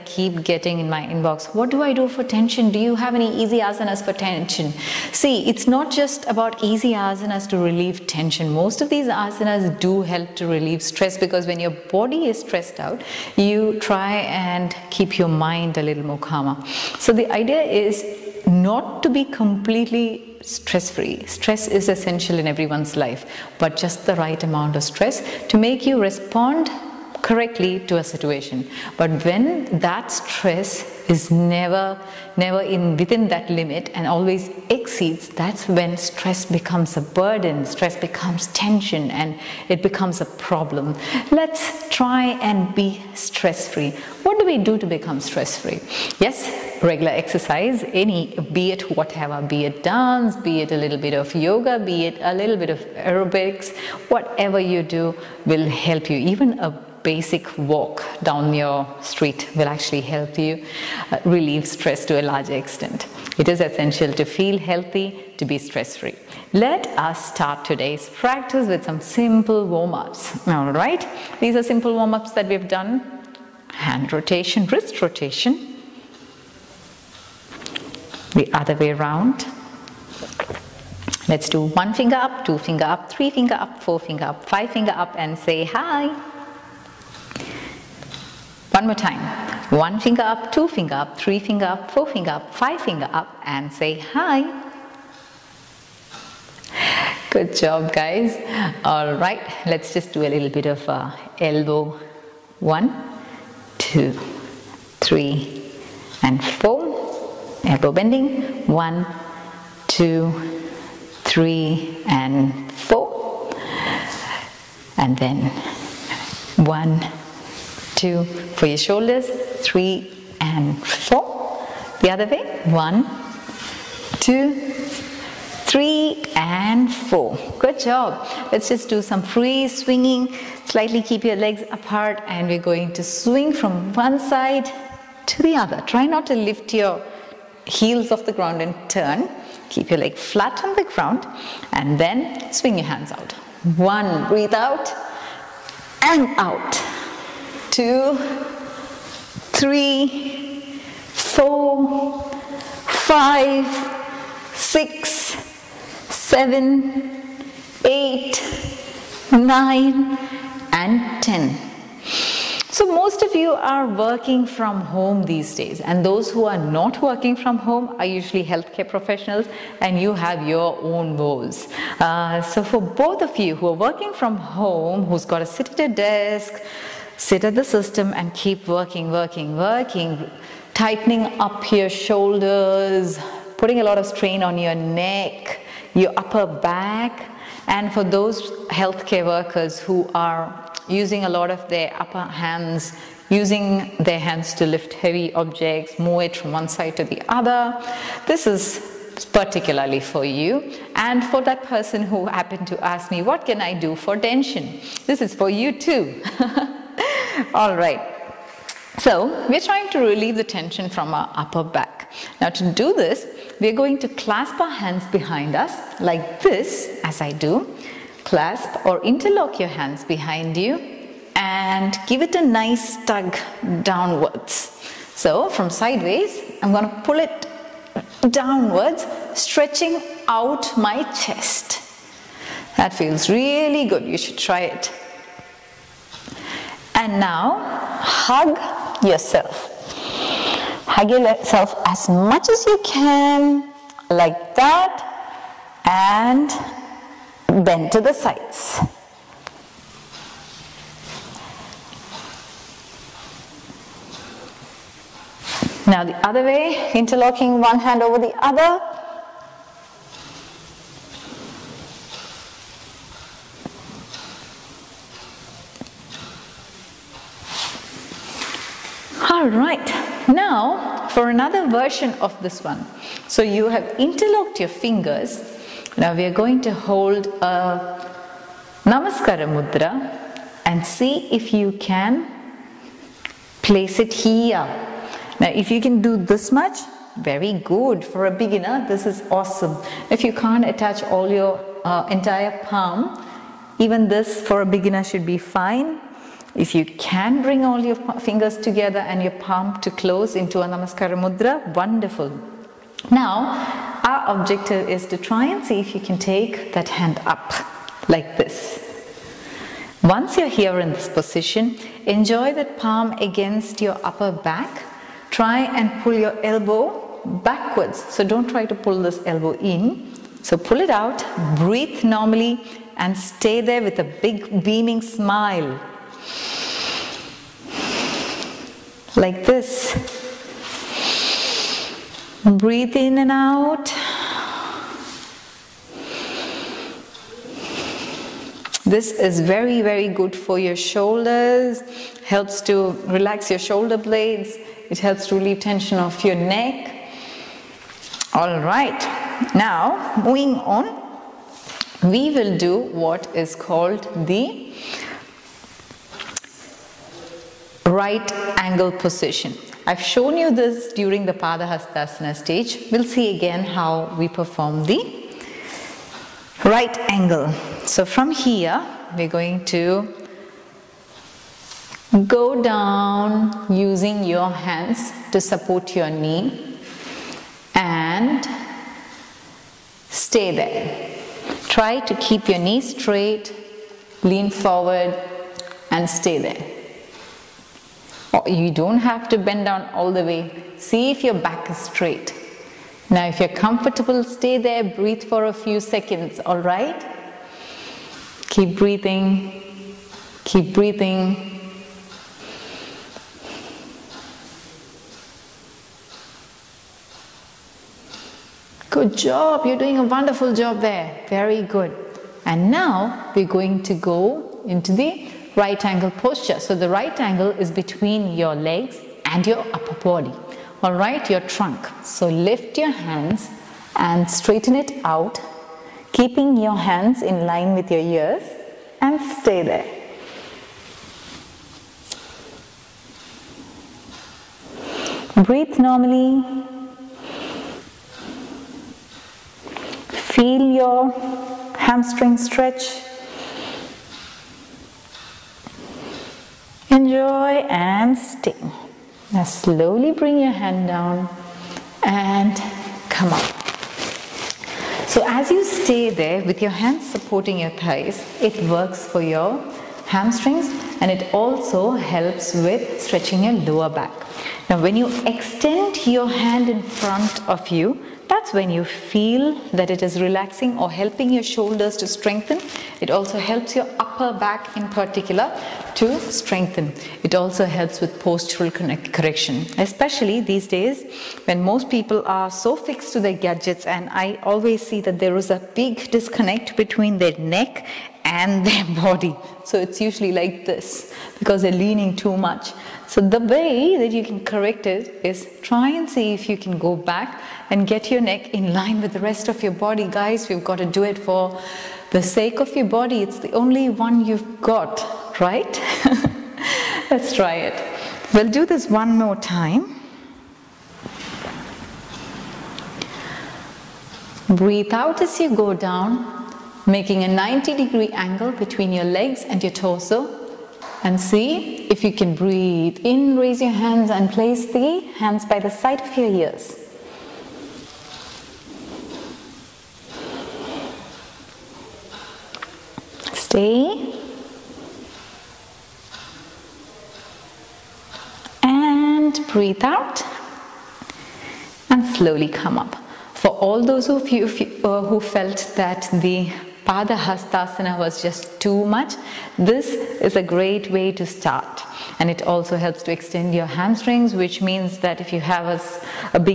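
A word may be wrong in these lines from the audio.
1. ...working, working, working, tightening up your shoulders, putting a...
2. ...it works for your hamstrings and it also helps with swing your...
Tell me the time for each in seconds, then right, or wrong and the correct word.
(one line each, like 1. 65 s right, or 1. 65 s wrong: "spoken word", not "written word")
1. 178 s right
2. 458 s wrong: "stretching", not "swing".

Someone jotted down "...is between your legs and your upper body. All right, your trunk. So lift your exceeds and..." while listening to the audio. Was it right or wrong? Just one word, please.
wrong.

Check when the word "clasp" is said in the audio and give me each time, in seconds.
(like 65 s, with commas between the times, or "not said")
214 s, 218 s.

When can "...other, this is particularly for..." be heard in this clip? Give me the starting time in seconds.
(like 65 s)
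197 s.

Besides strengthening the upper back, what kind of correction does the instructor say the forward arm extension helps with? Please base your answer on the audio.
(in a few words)
postural correction.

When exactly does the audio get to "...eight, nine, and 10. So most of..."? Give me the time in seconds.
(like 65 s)
157 s.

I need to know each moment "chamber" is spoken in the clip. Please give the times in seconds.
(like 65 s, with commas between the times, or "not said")
not said.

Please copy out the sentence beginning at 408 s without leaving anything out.
Good job, you're doing a wonderful job there.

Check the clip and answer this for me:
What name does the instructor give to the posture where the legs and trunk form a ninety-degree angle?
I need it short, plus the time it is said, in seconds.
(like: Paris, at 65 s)
right angle position, at 357 s.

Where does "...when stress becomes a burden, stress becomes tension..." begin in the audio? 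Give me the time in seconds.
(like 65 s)
35 s.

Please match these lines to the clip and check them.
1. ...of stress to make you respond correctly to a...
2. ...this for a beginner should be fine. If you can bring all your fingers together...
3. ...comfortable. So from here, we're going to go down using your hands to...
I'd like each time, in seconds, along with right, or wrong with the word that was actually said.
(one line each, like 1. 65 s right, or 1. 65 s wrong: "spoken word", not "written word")
1. 24 s right
2. 294 s right
3. 367 s wrong: "angle", not "comfortable".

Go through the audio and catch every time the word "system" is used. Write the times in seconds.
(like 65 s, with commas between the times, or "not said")
177 s.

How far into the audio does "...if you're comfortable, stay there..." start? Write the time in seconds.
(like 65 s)
393 s.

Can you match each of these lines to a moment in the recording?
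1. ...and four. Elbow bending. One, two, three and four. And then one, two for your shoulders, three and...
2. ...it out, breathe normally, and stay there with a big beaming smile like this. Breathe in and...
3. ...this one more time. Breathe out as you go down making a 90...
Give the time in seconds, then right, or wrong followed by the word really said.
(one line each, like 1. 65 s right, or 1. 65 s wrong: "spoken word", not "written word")
1. 106 s right
2. 320 s right
3. 508 s right.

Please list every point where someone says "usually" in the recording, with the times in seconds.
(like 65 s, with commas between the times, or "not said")
168 s, 490 s.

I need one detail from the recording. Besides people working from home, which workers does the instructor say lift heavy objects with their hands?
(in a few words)
healthcare workers.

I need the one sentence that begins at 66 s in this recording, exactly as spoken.
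Let us start today's practice with some simple warm-ups.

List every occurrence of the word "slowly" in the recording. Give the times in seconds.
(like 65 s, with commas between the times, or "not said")
449 s, 542 s.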